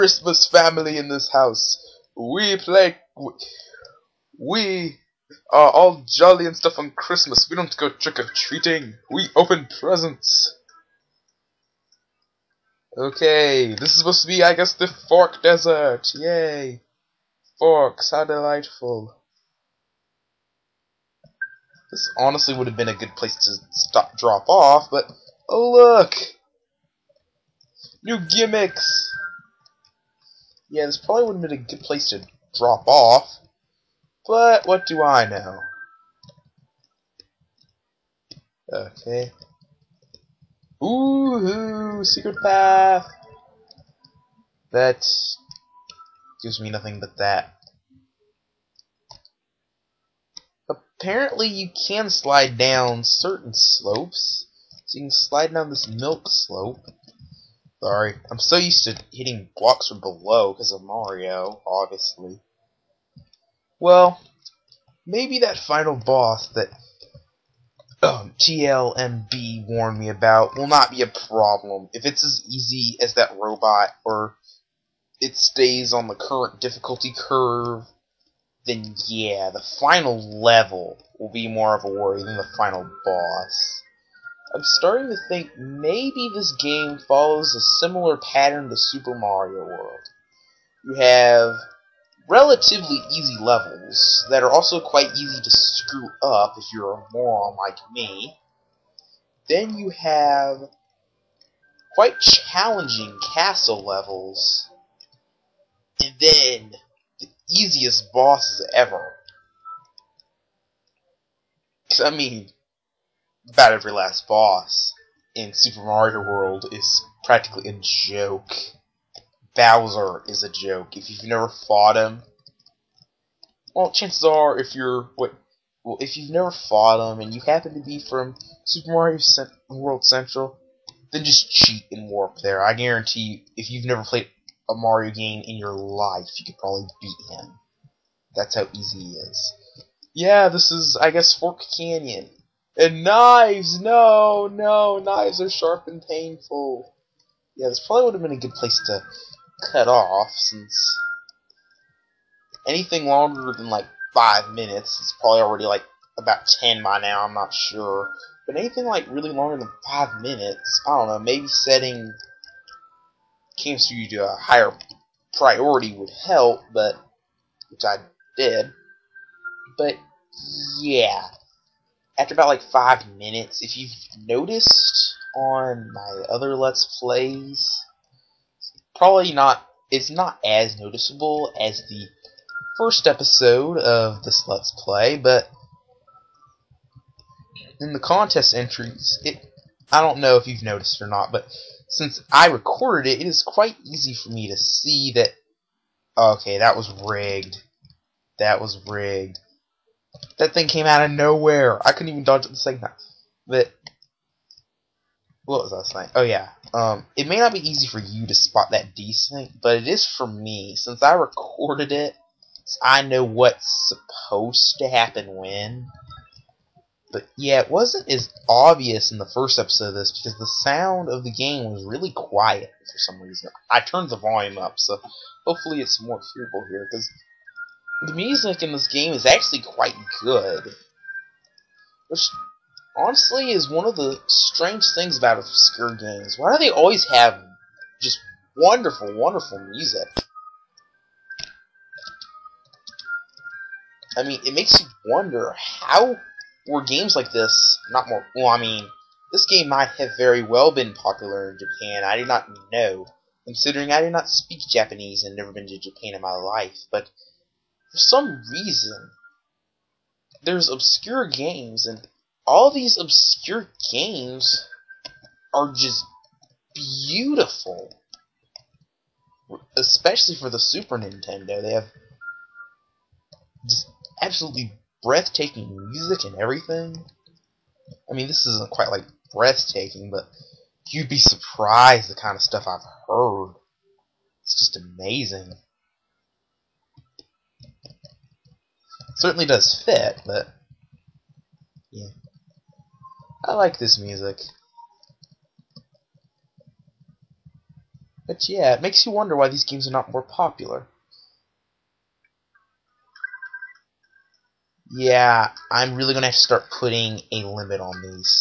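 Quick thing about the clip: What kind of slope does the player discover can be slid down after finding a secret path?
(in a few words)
milk slope.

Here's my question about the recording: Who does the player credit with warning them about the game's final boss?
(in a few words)
TLMB.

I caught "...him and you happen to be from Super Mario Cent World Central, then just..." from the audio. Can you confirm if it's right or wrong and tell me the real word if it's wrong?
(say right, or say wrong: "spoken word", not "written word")
right.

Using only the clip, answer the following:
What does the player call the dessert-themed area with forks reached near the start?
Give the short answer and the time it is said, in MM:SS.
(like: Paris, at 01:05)
Fork Desert, at 00:15.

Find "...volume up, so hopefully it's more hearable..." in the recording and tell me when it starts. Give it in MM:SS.
03:44.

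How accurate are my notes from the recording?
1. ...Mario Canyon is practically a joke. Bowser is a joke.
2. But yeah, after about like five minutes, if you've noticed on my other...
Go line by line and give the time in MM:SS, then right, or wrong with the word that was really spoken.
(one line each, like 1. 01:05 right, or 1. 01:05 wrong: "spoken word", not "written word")
1. 01:55 wrong: "World", not "Canyon"
2. 02:49 right.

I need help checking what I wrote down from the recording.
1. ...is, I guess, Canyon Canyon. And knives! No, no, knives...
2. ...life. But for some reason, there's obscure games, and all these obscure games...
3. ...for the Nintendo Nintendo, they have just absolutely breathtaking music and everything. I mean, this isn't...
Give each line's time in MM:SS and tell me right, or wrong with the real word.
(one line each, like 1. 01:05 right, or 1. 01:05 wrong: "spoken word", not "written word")
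1. 02:20 wrong: "Fork", not "Canyon"
2. 04:16 right
3. 04:30 wrong: "Super", not "Nintendo".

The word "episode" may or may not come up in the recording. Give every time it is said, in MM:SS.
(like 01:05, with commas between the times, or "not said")
03:03, 03:39.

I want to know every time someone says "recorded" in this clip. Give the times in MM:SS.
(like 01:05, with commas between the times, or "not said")
03:12, 03:31.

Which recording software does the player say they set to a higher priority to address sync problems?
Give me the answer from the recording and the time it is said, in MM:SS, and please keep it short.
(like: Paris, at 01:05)
Cam Studio, at 02:43.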